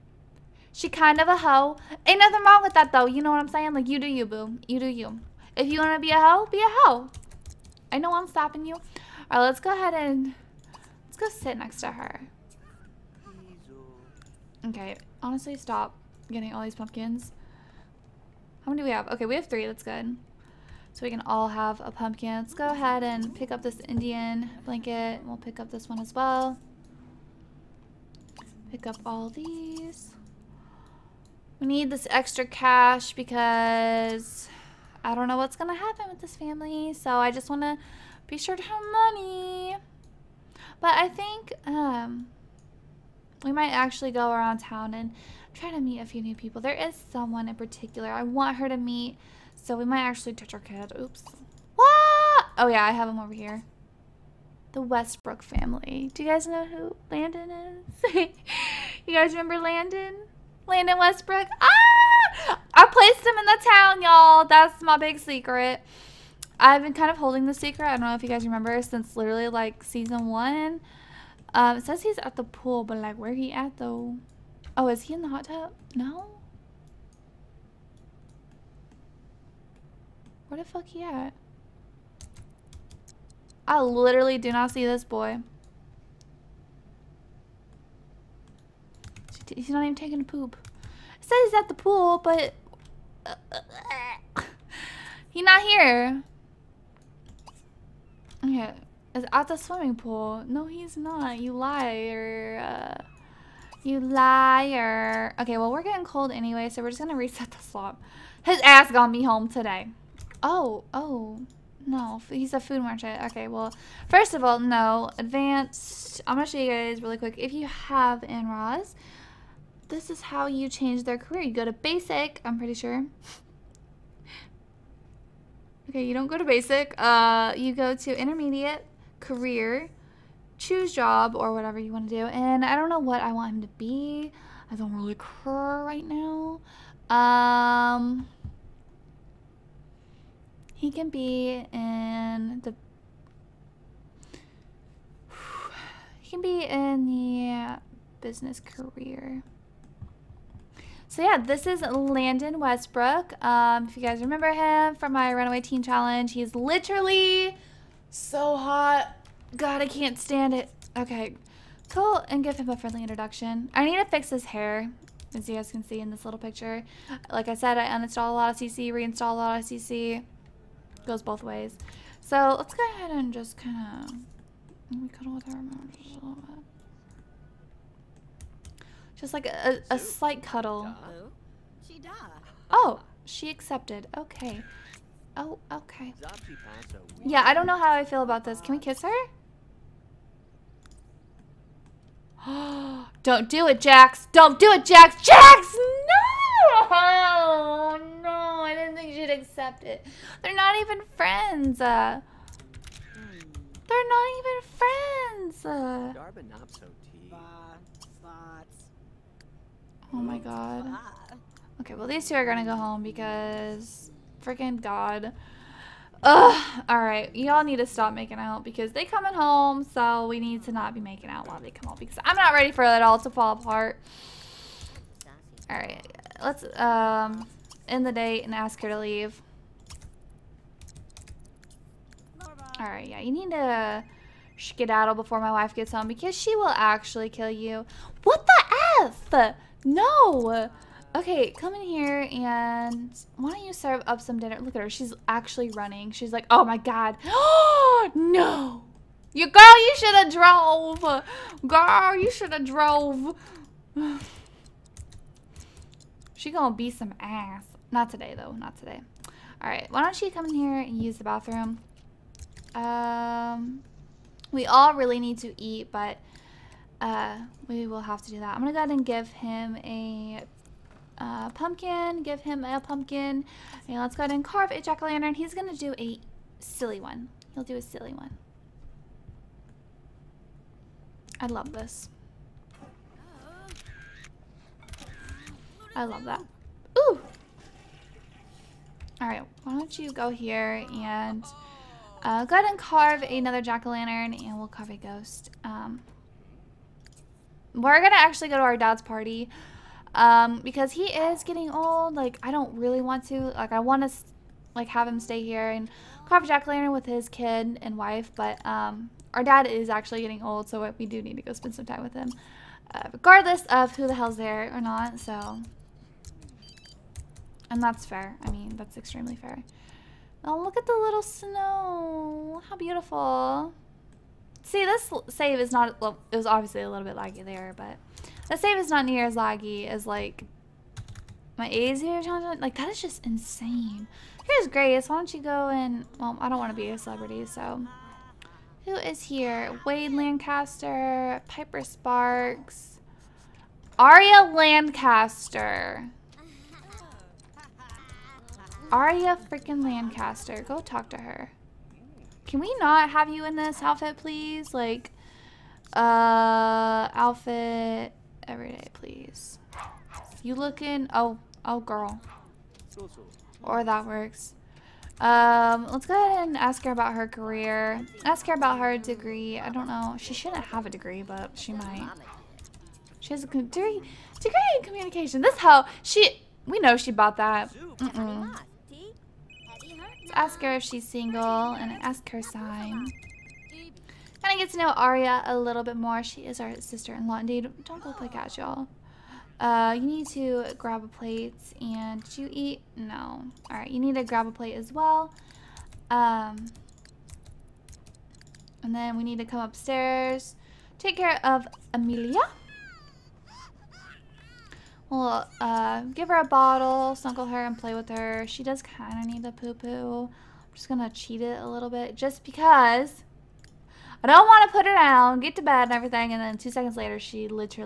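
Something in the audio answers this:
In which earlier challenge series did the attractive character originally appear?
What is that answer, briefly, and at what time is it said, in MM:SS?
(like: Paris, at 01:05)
Runaway Teen Challenge, at 02:35.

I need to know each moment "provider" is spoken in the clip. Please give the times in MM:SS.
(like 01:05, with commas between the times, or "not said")
not said.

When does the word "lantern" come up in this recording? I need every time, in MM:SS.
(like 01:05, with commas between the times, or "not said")
04:34, 04:53, 05:06.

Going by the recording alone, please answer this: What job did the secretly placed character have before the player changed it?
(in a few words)
Food merchant.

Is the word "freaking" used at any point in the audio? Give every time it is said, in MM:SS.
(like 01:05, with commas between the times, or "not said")
03:34, 05:49.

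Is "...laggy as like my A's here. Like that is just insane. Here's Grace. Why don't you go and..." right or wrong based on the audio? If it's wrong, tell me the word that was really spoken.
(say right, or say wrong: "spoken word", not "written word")
right.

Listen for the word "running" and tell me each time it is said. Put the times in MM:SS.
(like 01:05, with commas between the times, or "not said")
04:05.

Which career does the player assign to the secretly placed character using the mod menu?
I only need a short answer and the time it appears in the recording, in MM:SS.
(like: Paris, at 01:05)
Business, at 02:28.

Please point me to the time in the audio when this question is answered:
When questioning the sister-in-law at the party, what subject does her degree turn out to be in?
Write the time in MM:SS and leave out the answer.
06:14.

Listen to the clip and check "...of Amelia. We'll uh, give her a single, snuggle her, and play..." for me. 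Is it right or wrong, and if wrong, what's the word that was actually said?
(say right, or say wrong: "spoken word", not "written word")
wrong: "bottle", not "single".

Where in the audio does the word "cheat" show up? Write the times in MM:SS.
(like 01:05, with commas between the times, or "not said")
06:51.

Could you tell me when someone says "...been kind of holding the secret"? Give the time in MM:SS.
01:06.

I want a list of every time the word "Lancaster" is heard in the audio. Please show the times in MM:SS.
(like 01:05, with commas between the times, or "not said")
05:40, 05:44, 05:49.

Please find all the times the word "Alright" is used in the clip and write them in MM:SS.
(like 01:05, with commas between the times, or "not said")
03:36, 03:45, 03:52, 04:49.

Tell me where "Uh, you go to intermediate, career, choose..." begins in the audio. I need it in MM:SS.
02:06.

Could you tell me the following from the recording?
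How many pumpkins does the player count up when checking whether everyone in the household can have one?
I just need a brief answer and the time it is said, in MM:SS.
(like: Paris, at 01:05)
3, at 00:19.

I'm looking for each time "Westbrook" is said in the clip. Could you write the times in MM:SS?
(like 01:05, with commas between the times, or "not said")
00:54, 01:00, 02:32.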